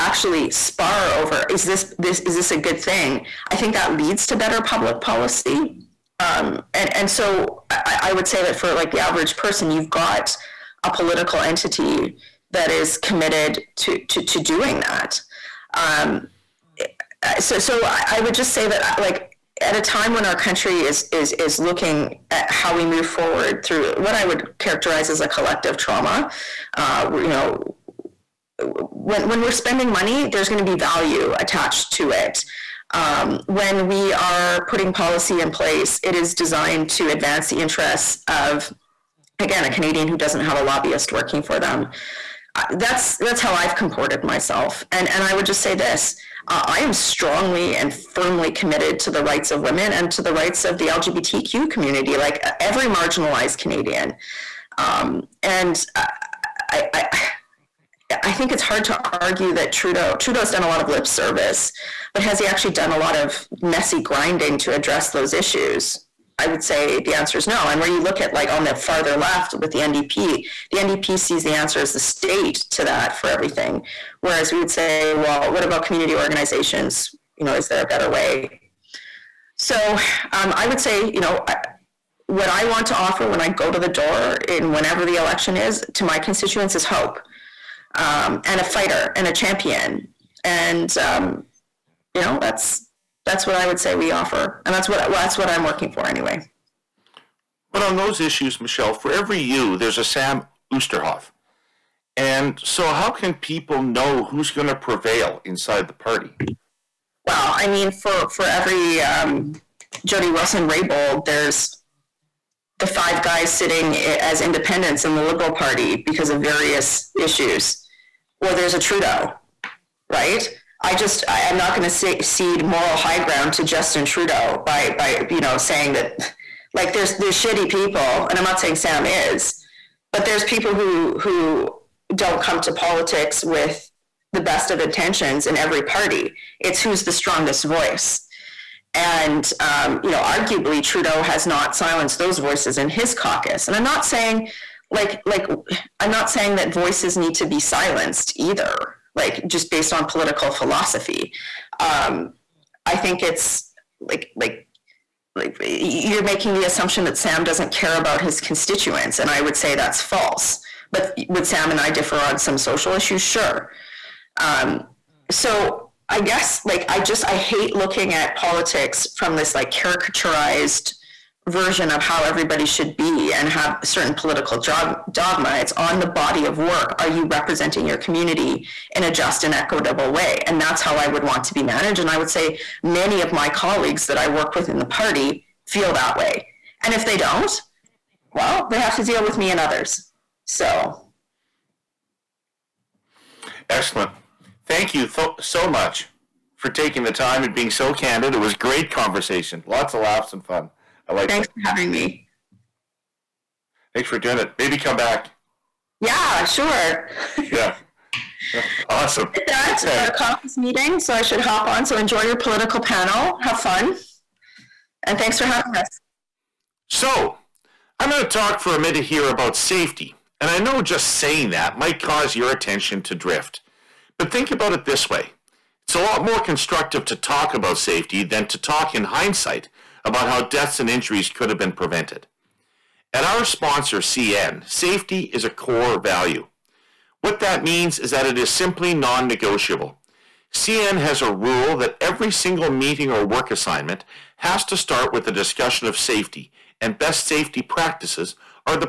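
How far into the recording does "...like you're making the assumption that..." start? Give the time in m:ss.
2:35.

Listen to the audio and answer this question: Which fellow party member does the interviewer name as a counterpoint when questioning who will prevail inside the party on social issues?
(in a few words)
Sam Oosterhoff.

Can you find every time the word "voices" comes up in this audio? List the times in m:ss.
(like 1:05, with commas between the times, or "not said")
2:17, 2:22, 2:26.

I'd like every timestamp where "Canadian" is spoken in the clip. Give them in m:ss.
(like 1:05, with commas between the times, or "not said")
0:39, 0:53.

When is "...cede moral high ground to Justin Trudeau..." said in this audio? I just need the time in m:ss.
2:02.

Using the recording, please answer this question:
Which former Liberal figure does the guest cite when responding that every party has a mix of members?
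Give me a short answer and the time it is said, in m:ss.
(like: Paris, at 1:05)
Jody Wilson Raybould, at 1:50.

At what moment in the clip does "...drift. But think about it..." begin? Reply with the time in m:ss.
3:43.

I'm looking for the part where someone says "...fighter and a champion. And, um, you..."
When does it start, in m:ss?
1:28.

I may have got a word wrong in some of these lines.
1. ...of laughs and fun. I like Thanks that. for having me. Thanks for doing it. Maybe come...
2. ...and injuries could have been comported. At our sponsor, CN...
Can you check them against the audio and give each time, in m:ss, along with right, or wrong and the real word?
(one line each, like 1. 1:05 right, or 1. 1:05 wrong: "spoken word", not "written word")
1. 3:19 right
2. 3:50 wrong: "prevented", not "comported".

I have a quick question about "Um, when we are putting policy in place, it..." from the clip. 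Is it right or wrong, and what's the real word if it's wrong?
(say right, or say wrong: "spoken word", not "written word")
right.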